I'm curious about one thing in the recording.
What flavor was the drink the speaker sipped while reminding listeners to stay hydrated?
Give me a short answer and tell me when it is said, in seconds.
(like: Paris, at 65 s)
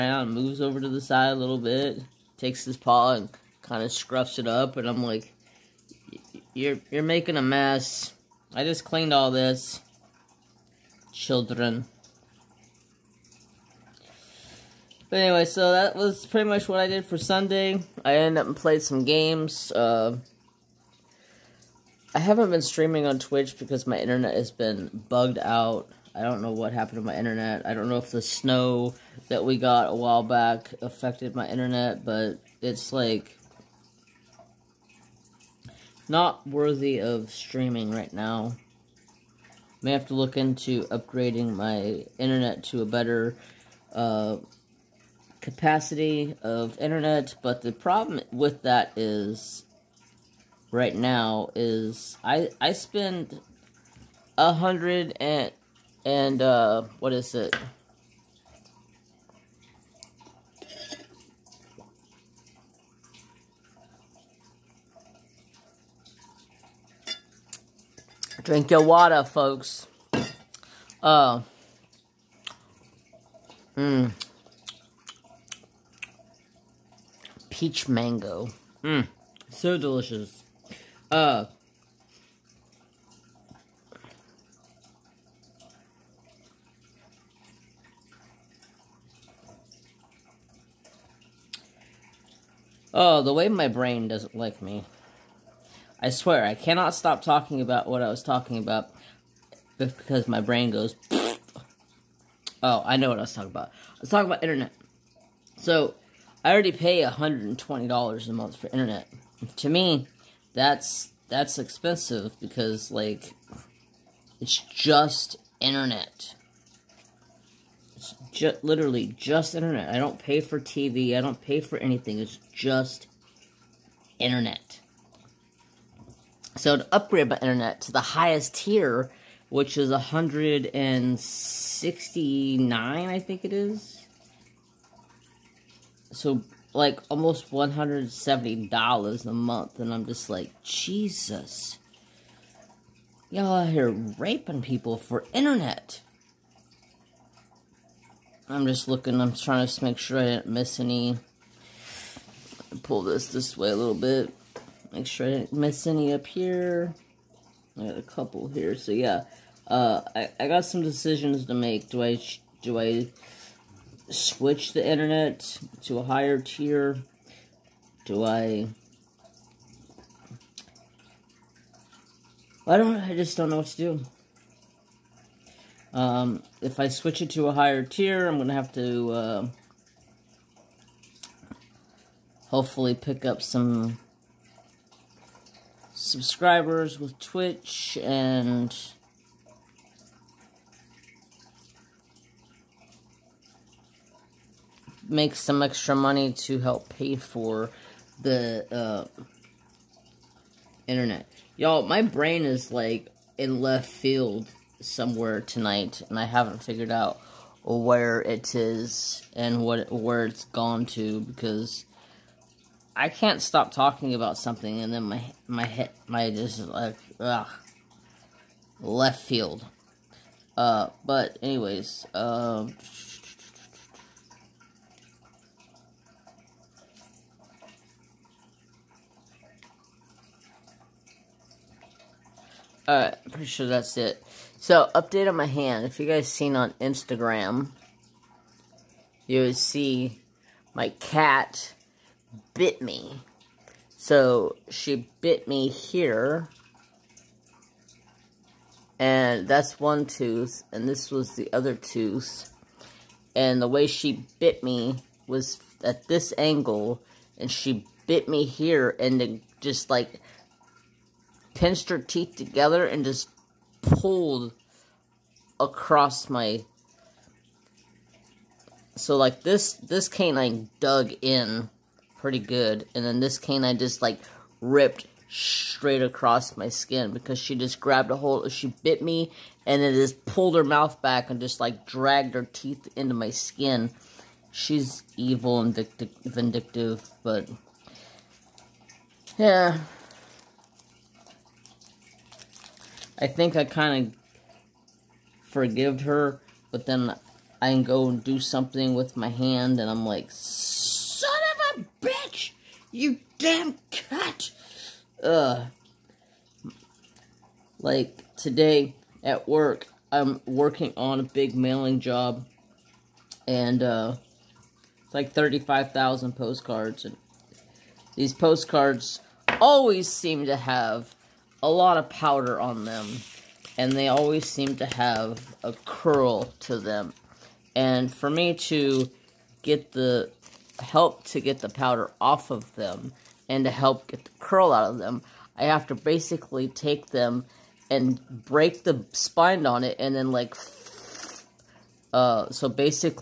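Peach mango, at 77 s.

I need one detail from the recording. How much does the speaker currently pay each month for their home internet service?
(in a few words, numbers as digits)
$120.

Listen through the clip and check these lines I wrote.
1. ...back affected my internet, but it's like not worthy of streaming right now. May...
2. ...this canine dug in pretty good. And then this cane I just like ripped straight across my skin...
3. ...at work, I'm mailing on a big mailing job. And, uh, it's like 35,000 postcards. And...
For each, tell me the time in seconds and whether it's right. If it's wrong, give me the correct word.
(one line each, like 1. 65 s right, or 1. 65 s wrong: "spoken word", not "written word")
1. 30 s right
2. 269 s right
3. 309 s wrong: "working", not "mailing".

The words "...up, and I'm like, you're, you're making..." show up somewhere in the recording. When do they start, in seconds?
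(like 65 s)
4 s.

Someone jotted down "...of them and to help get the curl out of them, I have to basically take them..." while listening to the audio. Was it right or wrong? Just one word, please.
right.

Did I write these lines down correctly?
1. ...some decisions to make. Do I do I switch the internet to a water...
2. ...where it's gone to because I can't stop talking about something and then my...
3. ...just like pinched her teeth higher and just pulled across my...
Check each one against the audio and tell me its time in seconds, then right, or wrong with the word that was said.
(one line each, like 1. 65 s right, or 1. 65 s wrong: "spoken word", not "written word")
1. 160 s wrong: "higher", not "water"
2. 209 s right
3. 259 s wrong: "together", not "higher".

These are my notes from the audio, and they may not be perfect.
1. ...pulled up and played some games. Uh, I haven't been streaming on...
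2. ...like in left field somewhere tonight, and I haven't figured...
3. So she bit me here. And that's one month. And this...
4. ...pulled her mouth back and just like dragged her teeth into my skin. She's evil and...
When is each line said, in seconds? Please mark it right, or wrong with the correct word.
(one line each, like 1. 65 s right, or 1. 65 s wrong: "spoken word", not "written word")
1. 18 s wrong: "ended", not "pulled"
2. 202 s right
3. 243 s wrong: "tooth", not "month"
4. 280 s right.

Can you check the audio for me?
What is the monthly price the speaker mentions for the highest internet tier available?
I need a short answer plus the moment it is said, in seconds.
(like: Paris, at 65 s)
169, at 129 s.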